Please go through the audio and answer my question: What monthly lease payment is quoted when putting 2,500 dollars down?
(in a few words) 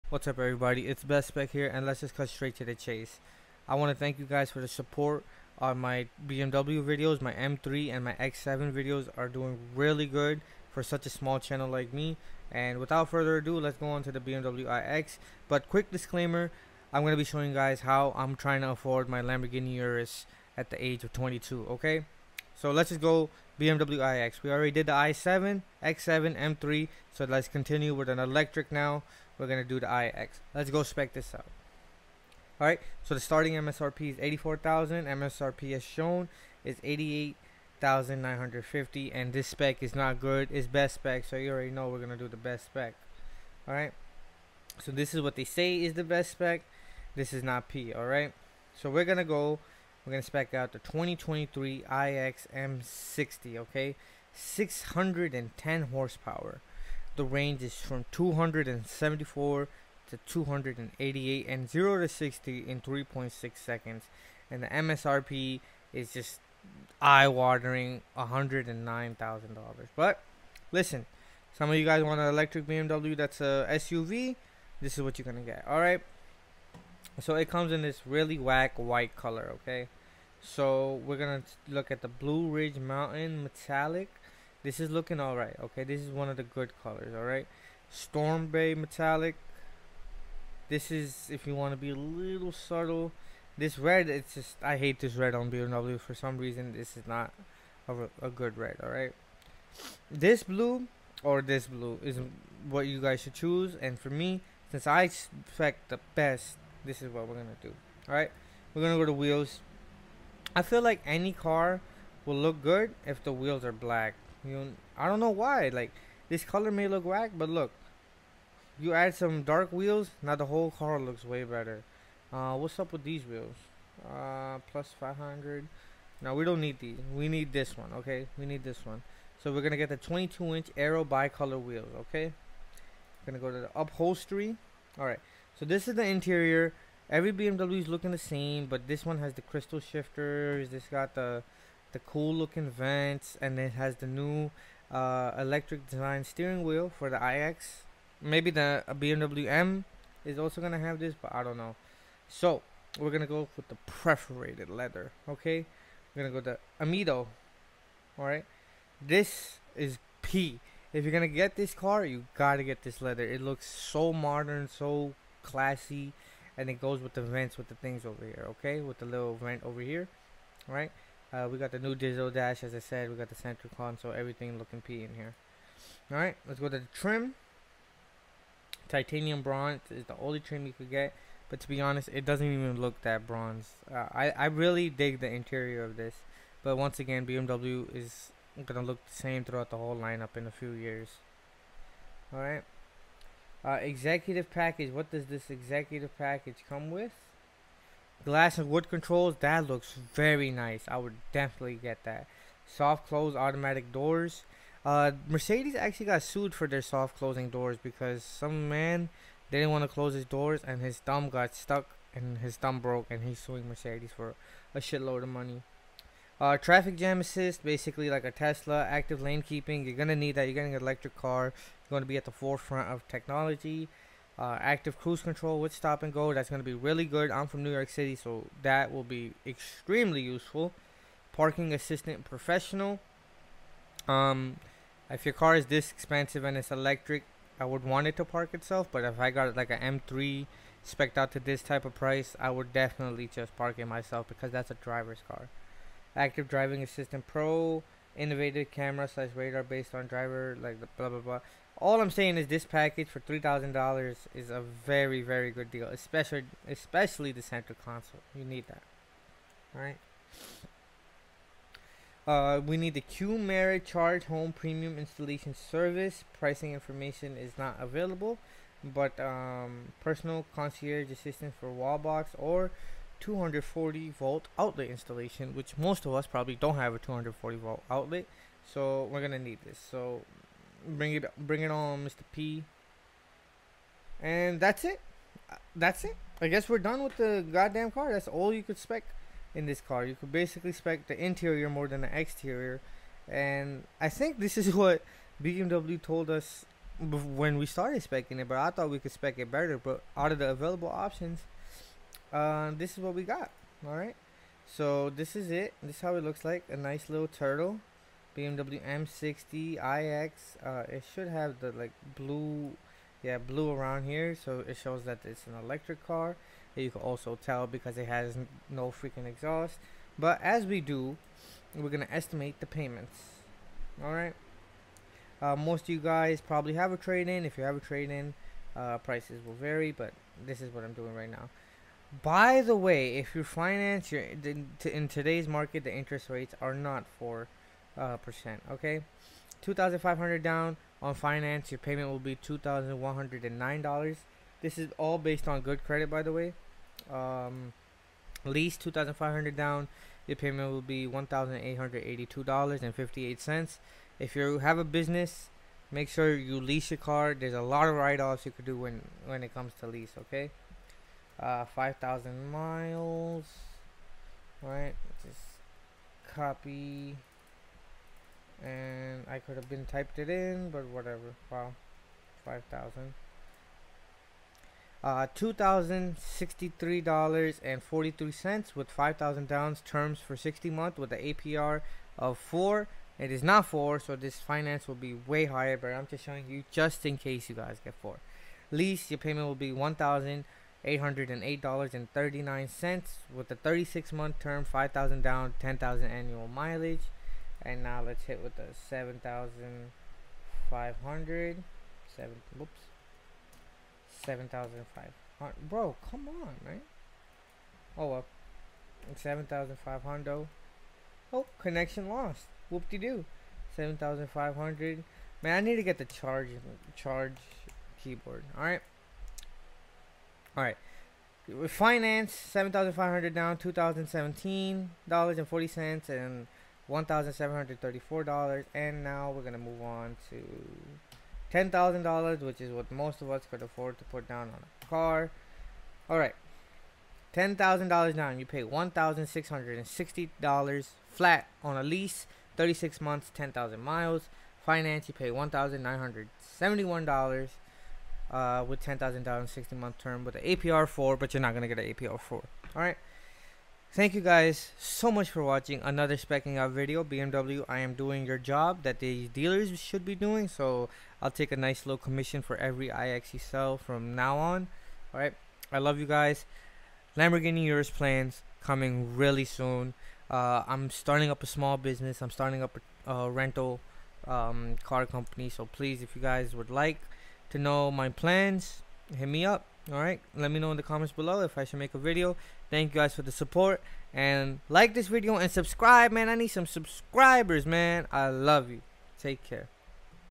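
$1,882.58.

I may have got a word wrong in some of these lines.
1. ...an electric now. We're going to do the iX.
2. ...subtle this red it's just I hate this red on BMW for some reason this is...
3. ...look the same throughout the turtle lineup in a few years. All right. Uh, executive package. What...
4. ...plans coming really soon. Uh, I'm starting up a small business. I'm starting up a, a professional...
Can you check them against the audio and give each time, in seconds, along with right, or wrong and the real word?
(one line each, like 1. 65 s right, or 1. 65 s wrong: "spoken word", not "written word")
1. 28 s right
2. 92 s right
3. 188 s wrong: "whole", not "turtle"
4. 467 s wrong: "rental", not "professional".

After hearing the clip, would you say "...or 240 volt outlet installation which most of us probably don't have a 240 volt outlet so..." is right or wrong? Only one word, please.
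right.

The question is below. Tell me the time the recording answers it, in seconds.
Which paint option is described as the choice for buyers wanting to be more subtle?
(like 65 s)
87 s.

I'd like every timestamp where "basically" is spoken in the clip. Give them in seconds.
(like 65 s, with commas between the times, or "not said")
217 s, 290 s.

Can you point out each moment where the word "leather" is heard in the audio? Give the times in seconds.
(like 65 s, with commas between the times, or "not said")
154 s, 162 s.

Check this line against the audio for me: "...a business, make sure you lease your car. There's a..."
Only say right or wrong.
right.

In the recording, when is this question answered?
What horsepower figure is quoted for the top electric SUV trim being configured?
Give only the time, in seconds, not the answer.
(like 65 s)
54 s.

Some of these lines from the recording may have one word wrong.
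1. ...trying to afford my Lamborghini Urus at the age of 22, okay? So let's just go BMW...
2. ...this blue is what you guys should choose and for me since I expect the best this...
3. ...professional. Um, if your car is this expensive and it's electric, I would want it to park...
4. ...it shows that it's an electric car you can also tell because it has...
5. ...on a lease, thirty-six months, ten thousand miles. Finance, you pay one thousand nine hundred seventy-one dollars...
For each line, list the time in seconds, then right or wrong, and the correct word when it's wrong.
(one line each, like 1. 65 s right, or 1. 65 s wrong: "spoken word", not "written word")
1. 18 s right
2. 101 s right
3. 232 s right
4. 314 s right
5. 441 s right.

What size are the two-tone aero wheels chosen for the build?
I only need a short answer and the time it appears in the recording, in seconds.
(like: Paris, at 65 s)
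22 inch, at 129 s.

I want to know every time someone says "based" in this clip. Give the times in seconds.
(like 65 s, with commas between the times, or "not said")
249 s, 345 s.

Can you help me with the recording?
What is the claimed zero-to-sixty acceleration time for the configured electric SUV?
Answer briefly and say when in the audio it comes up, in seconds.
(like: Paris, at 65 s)
3.6 seconds, at 62 s.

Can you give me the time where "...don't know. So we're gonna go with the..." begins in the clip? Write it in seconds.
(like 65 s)
151 s.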